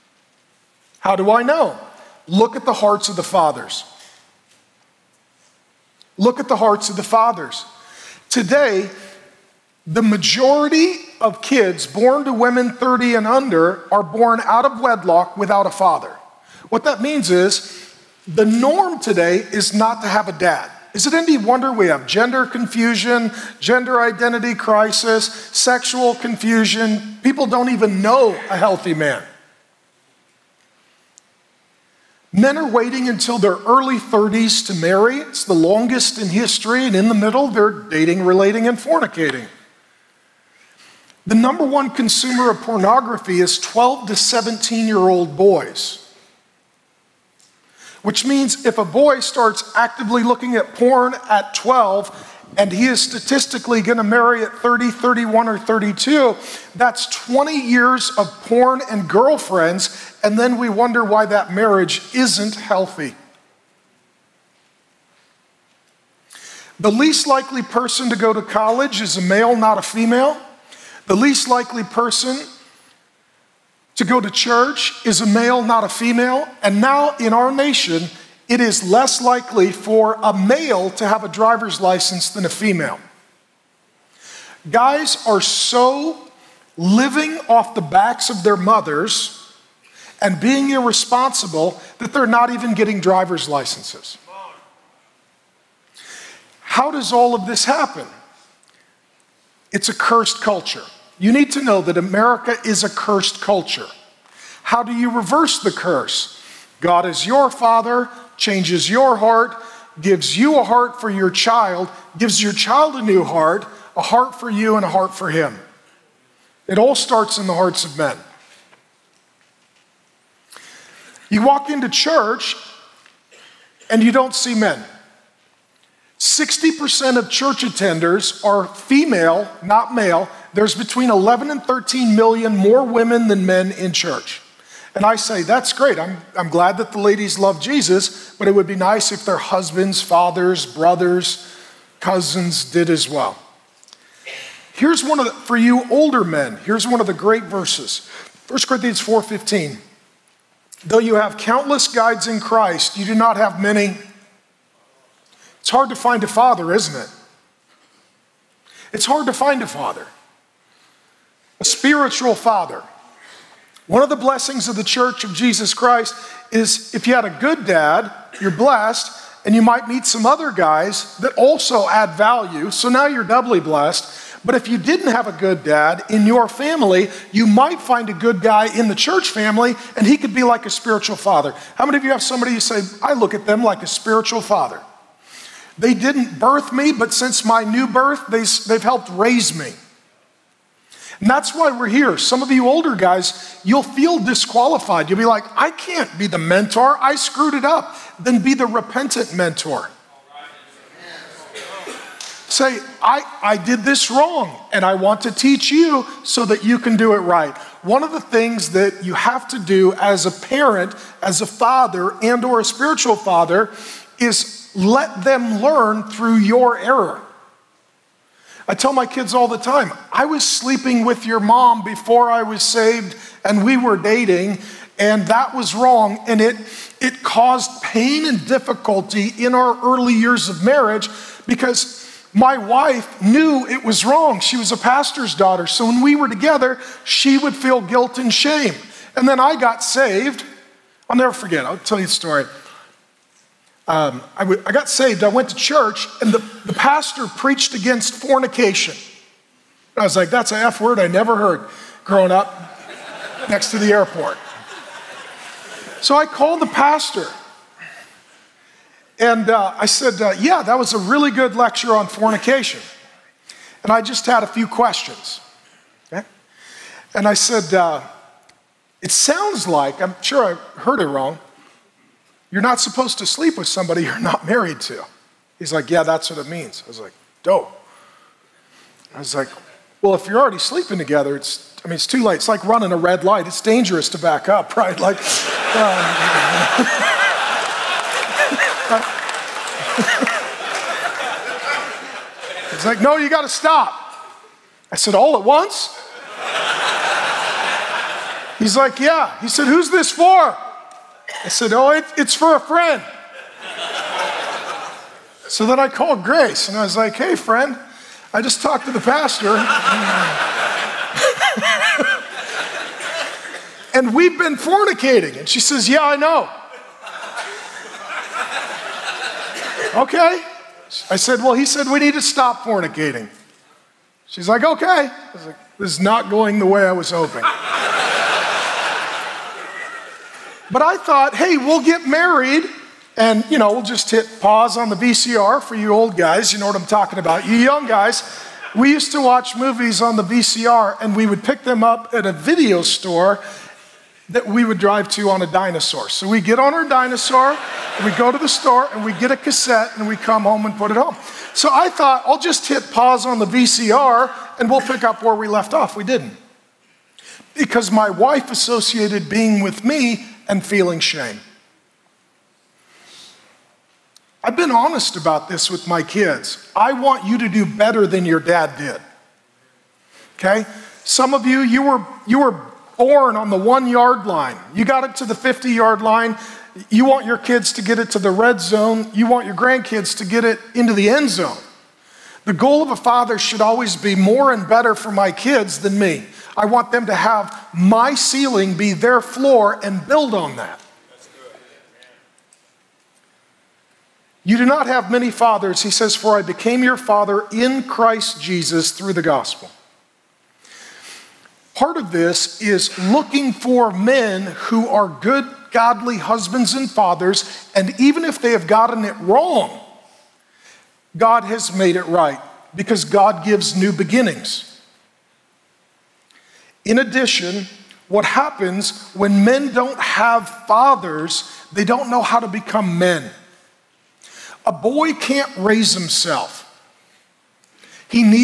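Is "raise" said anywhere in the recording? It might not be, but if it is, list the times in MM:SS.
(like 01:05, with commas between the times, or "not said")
03:09, 07:05.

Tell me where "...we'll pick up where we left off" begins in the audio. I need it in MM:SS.
05:54.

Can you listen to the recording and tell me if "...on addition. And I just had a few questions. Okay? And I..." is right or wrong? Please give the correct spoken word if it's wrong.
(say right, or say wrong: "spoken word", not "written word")
wrong: "fornication", not "addition".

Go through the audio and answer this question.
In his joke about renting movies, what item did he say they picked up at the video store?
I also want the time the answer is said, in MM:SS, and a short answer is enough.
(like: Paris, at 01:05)
A cassette, at 05:49.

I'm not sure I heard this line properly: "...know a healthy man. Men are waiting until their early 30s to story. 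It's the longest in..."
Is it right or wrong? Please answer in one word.
wrong.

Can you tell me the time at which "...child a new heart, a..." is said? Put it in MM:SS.
01:52.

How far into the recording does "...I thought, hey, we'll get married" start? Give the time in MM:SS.
05:30.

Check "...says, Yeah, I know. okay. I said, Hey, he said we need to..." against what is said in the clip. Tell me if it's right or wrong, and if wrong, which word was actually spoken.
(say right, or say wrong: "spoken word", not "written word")
wrong: "Well", not "Hey".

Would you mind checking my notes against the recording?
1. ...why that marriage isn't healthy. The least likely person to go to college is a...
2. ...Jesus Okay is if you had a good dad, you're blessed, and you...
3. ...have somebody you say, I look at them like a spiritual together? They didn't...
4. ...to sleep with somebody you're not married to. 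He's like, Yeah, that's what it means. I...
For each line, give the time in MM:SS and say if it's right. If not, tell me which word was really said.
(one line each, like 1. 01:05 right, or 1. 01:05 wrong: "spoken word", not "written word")
1. 01:01 right
2. 02:45 wrong: "Christ", not "Okay"
3. 03:02 wrong: "father", not "together"
4. 04:33 right.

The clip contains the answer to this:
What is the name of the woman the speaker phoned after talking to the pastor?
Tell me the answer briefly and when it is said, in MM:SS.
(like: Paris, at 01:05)
Grace, at 05:06.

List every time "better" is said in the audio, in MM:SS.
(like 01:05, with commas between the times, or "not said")
06:07, 06:24.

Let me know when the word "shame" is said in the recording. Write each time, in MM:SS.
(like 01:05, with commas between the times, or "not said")
03:58, 06:00.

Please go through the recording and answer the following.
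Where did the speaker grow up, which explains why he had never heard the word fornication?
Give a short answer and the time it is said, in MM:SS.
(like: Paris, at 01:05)
Next to the airport, at 04:13.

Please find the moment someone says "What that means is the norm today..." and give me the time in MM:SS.
00:16.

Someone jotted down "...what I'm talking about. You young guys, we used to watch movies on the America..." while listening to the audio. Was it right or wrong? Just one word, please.
wrong.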